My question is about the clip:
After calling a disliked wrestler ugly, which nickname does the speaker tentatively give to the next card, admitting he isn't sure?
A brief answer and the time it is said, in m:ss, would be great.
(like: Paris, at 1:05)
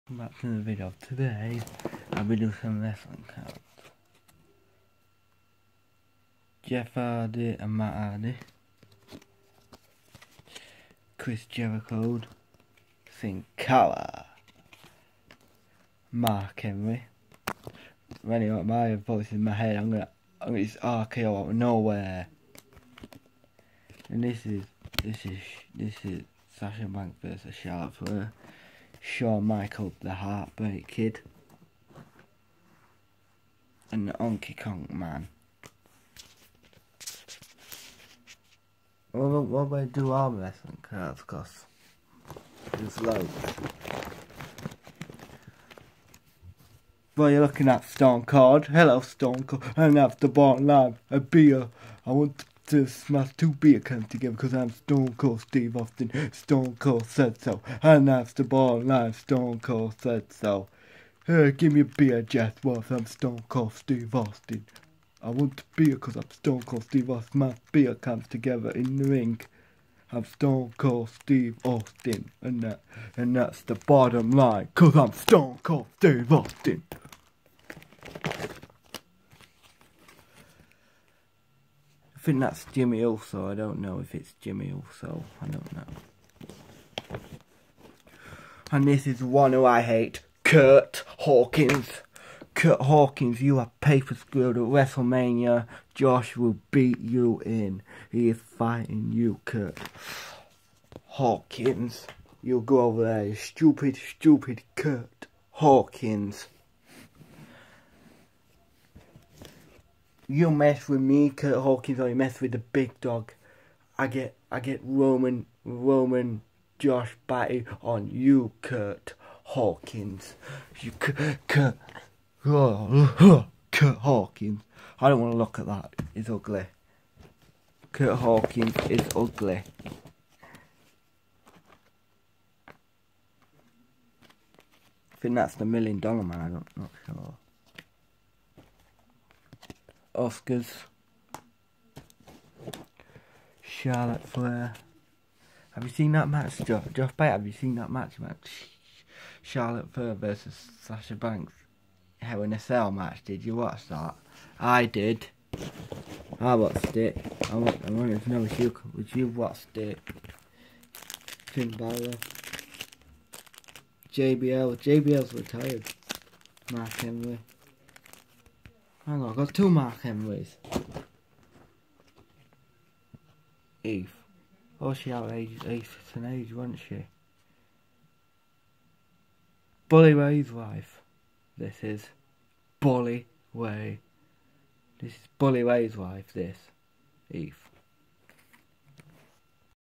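Million Dollar Man, at 2:15.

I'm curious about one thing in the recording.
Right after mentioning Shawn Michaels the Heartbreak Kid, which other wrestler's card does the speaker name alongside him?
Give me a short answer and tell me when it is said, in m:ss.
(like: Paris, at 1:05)
Honky Tonk Man, at 0:34.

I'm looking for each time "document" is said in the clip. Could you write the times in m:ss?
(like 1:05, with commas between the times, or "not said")
not said.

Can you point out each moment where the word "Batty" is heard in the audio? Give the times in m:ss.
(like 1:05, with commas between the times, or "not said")
1:57.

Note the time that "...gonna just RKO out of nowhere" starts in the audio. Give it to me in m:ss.
0:20.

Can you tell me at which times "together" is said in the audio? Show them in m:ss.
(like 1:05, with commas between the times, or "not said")
0:54, 1:08.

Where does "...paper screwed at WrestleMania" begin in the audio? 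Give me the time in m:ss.
1:33.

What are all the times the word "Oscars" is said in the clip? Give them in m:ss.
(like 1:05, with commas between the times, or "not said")
2:20.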